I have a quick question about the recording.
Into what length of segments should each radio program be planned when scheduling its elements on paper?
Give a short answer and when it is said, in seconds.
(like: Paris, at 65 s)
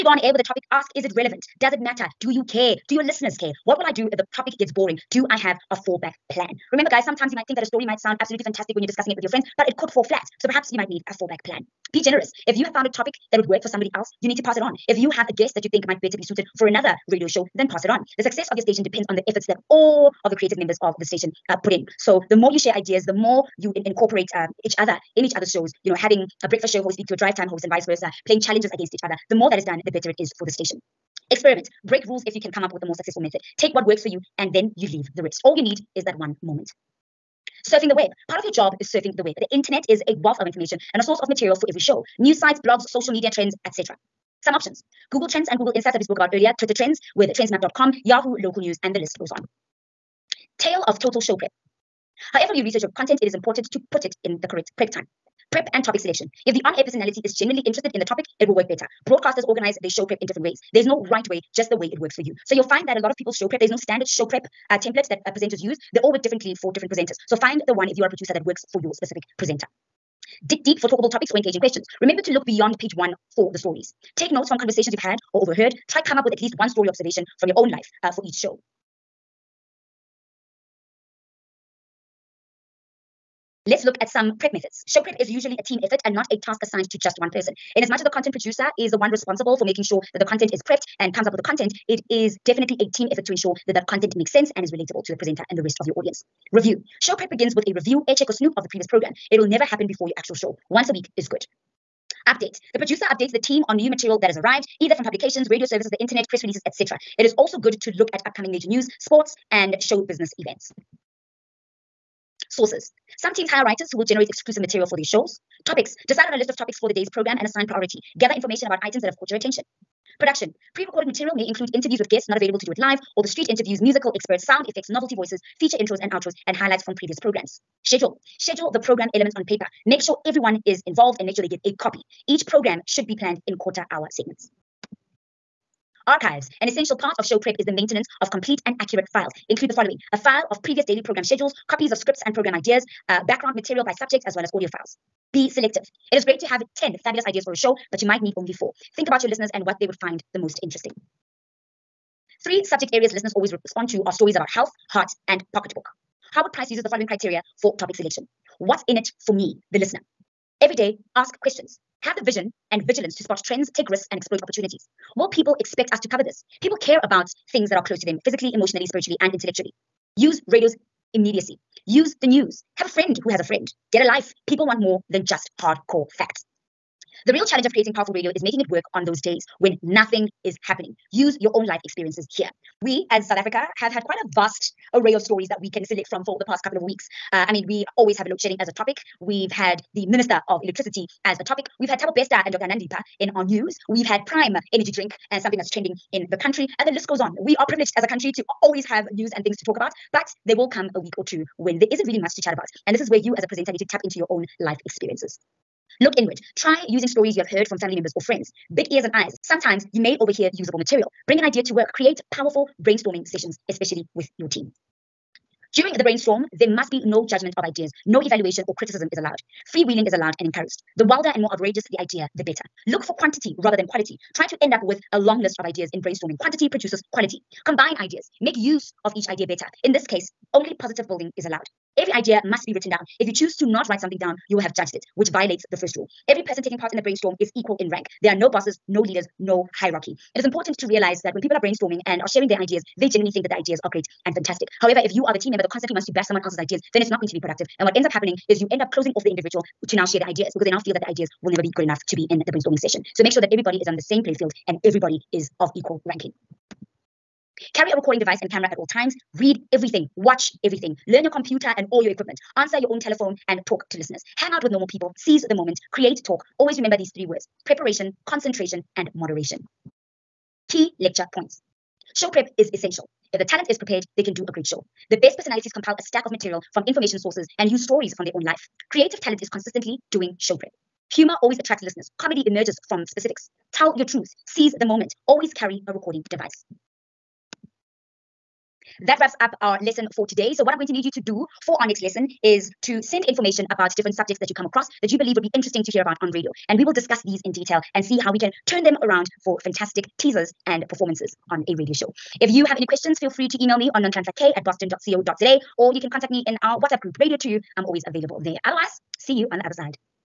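Quarter hour, at 133 s.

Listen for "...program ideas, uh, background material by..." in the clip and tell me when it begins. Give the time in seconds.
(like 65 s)
142 s.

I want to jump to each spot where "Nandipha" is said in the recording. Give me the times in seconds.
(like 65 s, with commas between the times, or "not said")
192 s.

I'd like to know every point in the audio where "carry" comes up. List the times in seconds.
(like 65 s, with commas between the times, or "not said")
257 s, 285 s.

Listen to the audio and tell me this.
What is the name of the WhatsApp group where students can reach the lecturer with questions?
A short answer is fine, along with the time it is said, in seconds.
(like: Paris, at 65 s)
Radio 2, at 307 s.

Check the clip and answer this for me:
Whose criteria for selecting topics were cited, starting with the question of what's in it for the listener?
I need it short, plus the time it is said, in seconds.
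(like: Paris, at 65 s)
Howard Price, at 156 s.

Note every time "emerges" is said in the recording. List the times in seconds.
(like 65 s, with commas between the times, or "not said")
282 s.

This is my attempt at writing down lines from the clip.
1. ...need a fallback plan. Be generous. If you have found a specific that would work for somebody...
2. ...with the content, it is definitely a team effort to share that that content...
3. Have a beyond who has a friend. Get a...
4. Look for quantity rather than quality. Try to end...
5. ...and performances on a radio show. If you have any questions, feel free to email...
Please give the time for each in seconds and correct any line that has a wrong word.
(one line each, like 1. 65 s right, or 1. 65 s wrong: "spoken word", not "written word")
1. 10 s wrong: "topic", not "specific"
2. 91 s wrong: "ensure", not "share"
3. 172 s wrong: "friend", not "beyond"
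4. 222 s right
5. 300 s right.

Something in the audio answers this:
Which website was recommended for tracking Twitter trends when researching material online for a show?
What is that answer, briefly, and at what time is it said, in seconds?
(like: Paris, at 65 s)
trendsmap.com, at 47 s.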